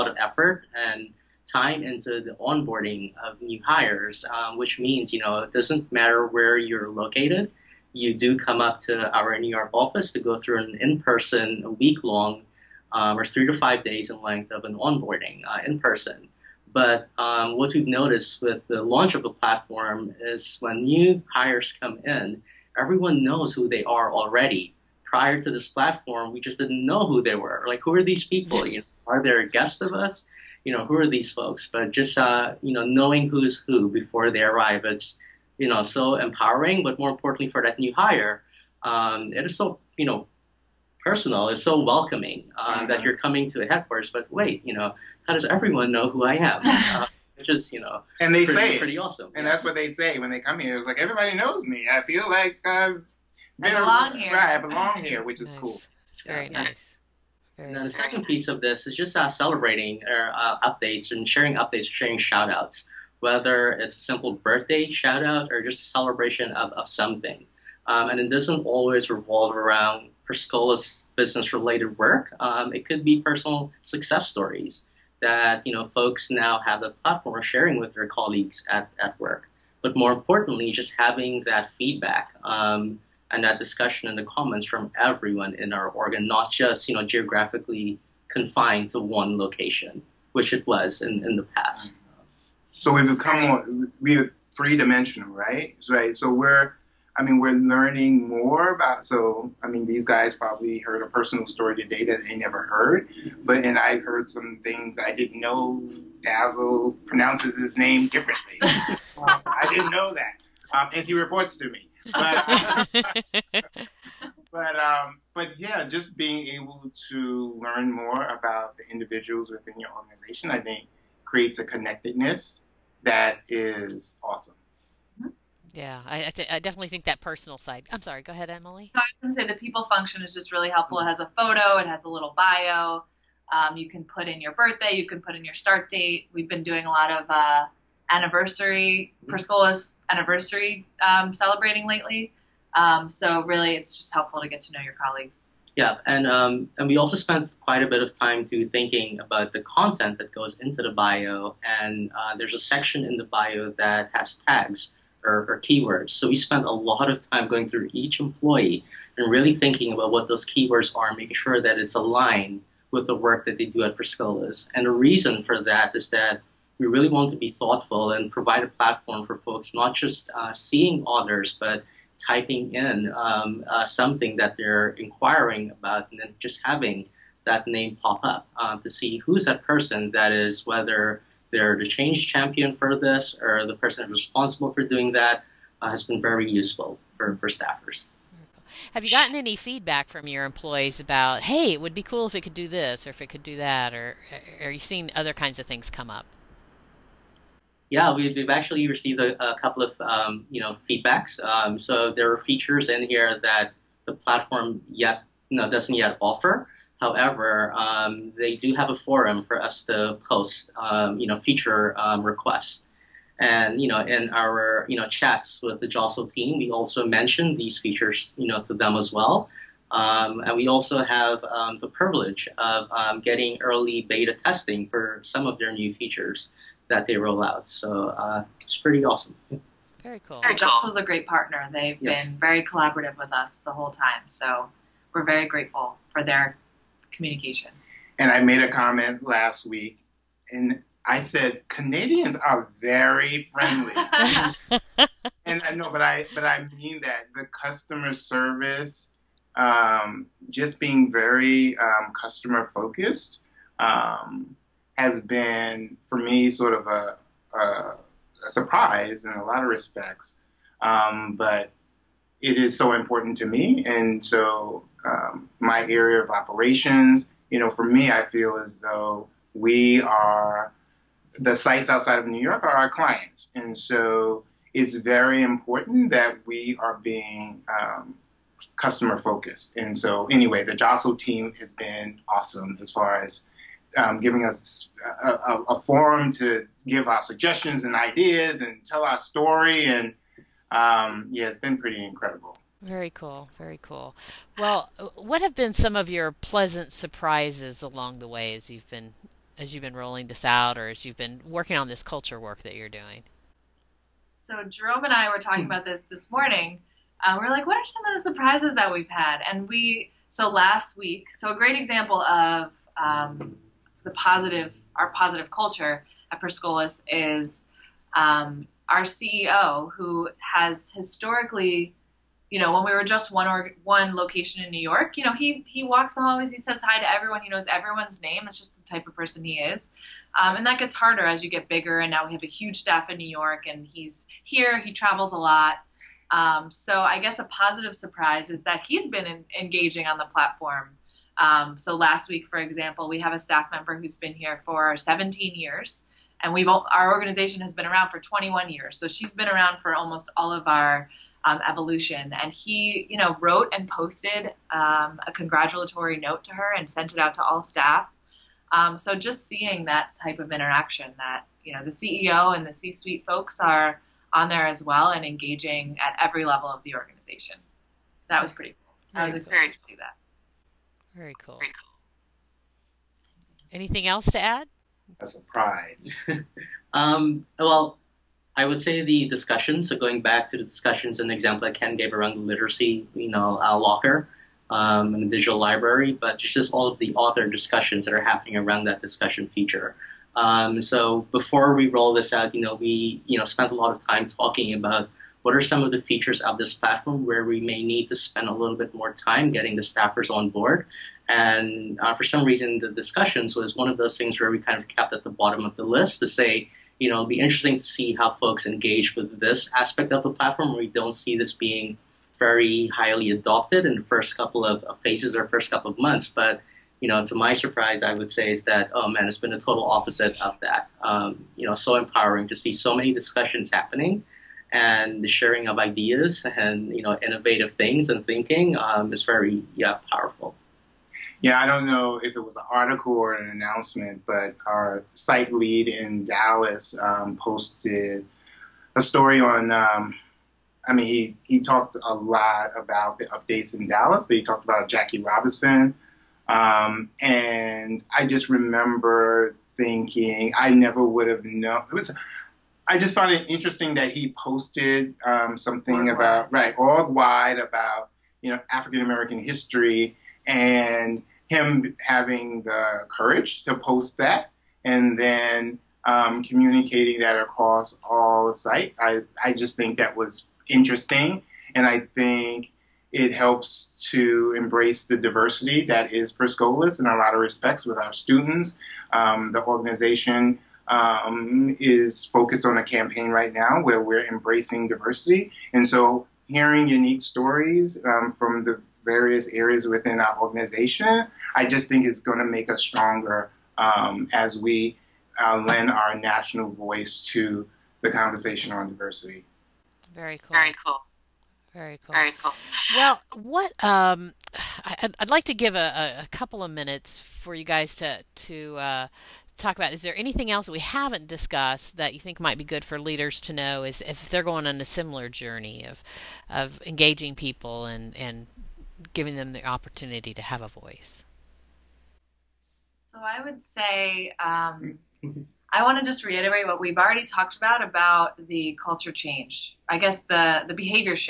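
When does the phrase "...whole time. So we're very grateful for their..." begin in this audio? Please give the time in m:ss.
3:53.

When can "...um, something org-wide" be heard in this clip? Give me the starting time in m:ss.
7:35.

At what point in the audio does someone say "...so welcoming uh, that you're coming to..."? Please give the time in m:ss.
0:41.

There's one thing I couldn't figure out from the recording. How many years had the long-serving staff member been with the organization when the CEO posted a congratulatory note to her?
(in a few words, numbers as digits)
17.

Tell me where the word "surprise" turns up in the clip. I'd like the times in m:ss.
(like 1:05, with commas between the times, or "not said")
4:18, 4:56, 5:08, 5:37, 6:15, 6:57.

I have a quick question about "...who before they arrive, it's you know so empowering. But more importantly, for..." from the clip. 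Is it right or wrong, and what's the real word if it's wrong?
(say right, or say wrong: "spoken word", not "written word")
right.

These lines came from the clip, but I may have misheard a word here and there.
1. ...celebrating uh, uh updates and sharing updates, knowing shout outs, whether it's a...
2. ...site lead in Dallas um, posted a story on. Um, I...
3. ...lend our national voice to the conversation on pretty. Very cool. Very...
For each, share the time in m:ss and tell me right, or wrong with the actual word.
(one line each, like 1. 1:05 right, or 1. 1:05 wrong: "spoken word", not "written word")
1. 0:59 wrong: "sharing", not "knowing"
2. 7:15 right
3. 8:15 wrong: "diversity", not "pretty".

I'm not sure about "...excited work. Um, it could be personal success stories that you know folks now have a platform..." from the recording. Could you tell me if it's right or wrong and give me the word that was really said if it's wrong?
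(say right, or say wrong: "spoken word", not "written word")
wrong: "related", not "excited".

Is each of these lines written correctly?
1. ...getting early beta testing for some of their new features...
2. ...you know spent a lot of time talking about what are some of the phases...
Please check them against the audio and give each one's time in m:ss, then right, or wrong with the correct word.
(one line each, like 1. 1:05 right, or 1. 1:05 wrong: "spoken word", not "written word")
1. 3:43 right
2. 6:33 wrong: "features", not "phases".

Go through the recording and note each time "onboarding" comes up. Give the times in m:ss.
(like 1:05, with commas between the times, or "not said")
0:02, 0:14.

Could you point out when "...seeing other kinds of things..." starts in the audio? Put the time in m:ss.
3:14.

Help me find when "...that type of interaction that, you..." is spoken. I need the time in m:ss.
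5:59.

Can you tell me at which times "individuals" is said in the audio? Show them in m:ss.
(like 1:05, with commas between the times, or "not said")
1:58.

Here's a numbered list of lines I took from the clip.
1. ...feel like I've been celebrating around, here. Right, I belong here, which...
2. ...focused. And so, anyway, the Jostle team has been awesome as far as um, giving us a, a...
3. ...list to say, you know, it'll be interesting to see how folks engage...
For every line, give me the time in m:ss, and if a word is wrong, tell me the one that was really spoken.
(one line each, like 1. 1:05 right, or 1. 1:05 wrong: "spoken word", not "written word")
1. 0:52 wrong: "belong", not "celebrating"
2. 4:39 right
3. 6:45 right.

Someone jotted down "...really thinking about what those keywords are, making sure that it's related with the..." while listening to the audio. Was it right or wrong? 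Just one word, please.
wrong.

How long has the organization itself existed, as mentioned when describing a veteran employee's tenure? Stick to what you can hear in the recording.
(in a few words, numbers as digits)
21 years.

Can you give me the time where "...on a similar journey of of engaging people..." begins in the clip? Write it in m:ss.
8:34.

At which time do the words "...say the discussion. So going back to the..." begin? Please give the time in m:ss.
6:18.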